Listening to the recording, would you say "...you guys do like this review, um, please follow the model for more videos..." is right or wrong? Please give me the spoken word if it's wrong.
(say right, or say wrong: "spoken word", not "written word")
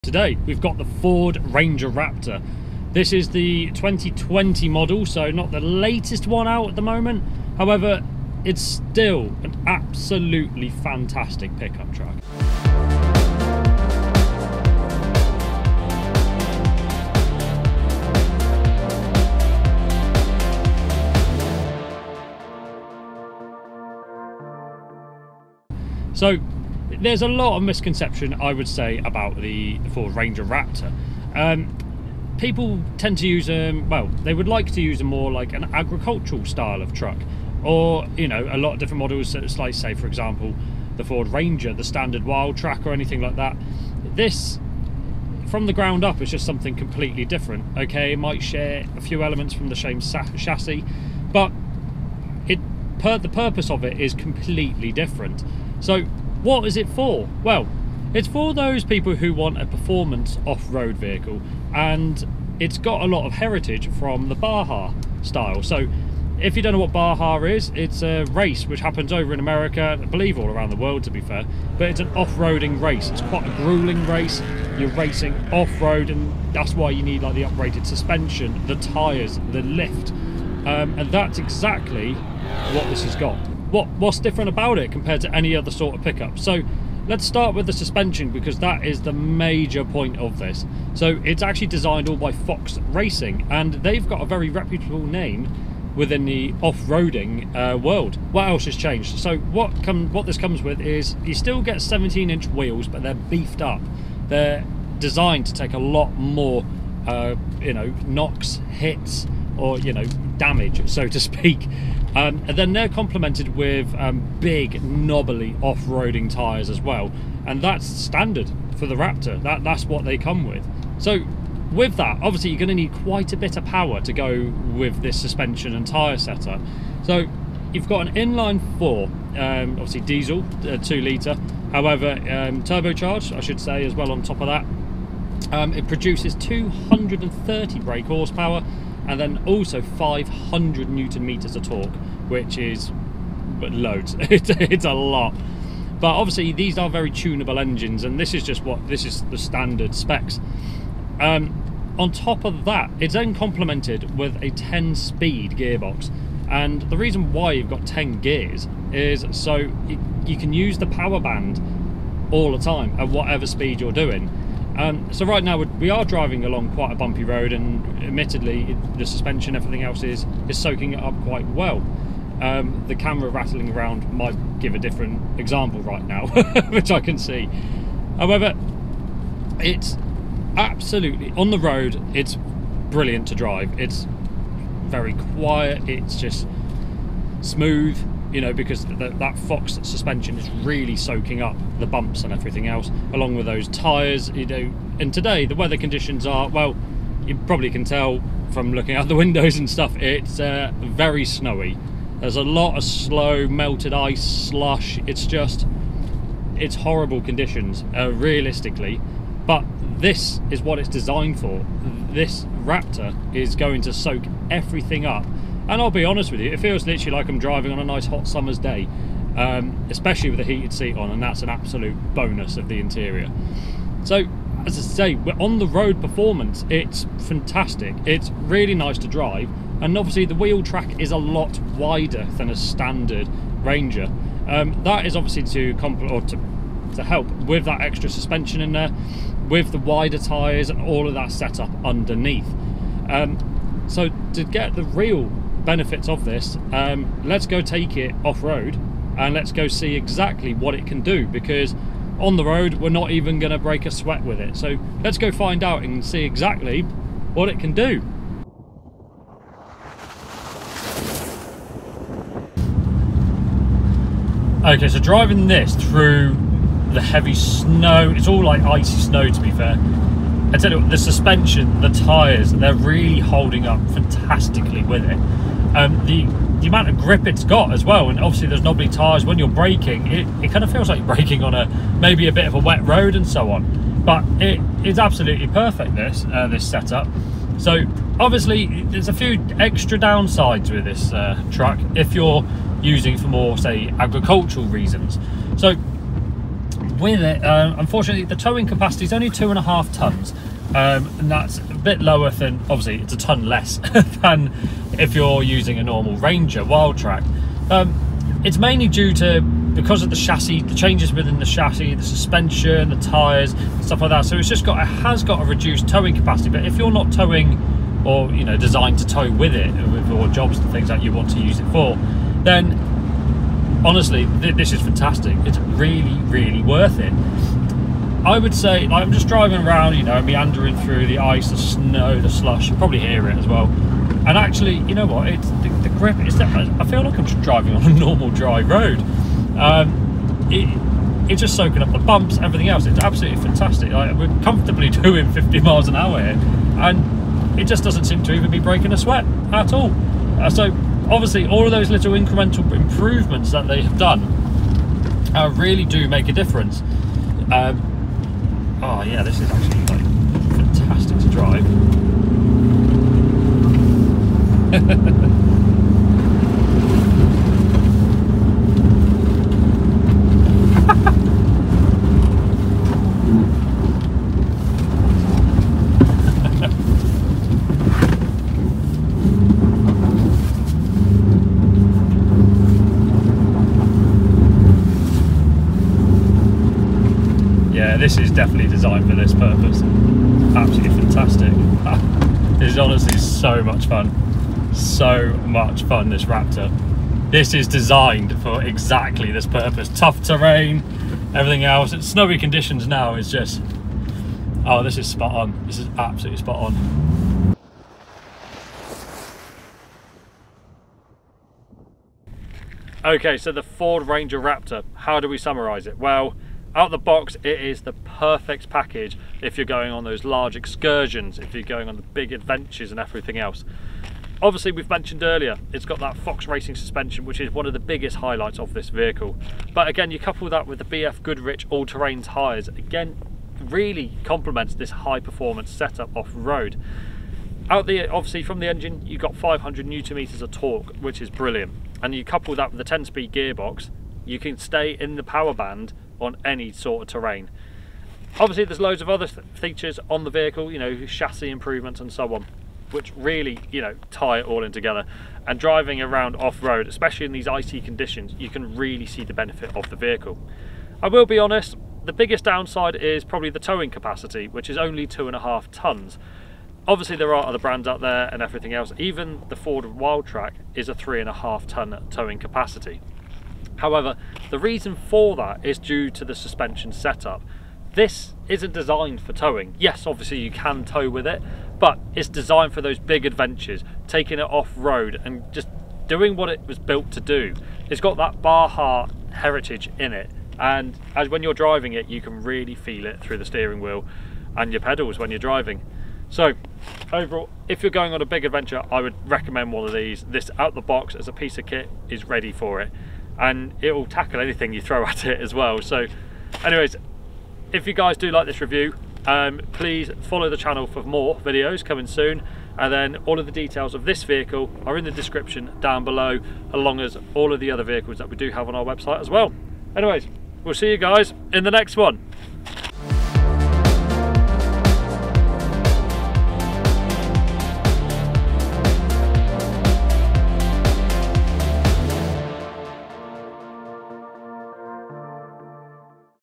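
wrong: "channel", not "model".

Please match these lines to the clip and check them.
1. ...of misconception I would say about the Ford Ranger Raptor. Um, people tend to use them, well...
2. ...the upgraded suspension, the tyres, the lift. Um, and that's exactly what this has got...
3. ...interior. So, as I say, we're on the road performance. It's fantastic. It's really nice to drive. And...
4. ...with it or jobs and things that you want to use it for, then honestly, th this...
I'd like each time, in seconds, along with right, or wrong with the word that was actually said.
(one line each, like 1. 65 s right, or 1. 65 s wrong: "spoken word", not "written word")
1. 27 s right
2. 77 s right
3. 222 s right
4. 319 s right.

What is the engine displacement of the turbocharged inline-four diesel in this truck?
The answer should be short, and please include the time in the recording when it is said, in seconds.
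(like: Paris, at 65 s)
2 litre, at 130 s.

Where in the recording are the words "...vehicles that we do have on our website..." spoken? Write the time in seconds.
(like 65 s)
517 s.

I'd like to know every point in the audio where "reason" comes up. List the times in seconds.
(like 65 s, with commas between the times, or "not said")
156 s, 294 s, 474 s.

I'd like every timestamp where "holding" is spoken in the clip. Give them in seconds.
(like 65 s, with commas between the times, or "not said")
273 s.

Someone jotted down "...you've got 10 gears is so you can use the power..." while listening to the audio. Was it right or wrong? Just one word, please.
right.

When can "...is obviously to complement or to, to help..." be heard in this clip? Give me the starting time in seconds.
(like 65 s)
235 s.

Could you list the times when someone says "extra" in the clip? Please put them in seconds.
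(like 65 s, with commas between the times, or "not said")
237 s, 289 s.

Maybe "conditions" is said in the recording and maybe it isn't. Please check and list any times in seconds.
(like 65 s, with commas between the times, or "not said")
195 s, 207 s, 402 s, 457 s.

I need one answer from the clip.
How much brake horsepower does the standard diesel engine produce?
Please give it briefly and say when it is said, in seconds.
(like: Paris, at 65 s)
230, at 136 s.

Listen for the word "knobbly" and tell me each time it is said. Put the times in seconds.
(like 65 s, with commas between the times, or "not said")
114 s, 278 s.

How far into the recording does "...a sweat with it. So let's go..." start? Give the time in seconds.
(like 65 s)
253 s.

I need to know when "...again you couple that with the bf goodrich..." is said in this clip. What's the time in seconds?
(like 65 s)
429 s.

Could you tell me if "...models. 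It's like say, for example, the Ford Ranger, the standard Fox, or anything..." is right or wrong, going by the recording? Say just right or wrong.
wrong.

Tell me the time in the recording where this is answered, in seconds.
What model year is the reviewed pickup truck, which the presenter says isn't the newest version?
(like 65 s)
3 s.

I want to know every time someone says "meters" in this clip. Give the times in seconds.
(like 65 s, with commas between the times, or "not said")
141 s, 440 s.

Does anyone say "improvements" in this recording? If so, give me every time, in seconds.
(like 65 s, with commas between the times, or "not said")
352 s, 451 s.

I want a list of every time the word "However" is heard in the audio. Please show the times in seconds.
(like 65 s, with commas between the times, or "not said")
7 s, 131 s, 178 s, 473 s.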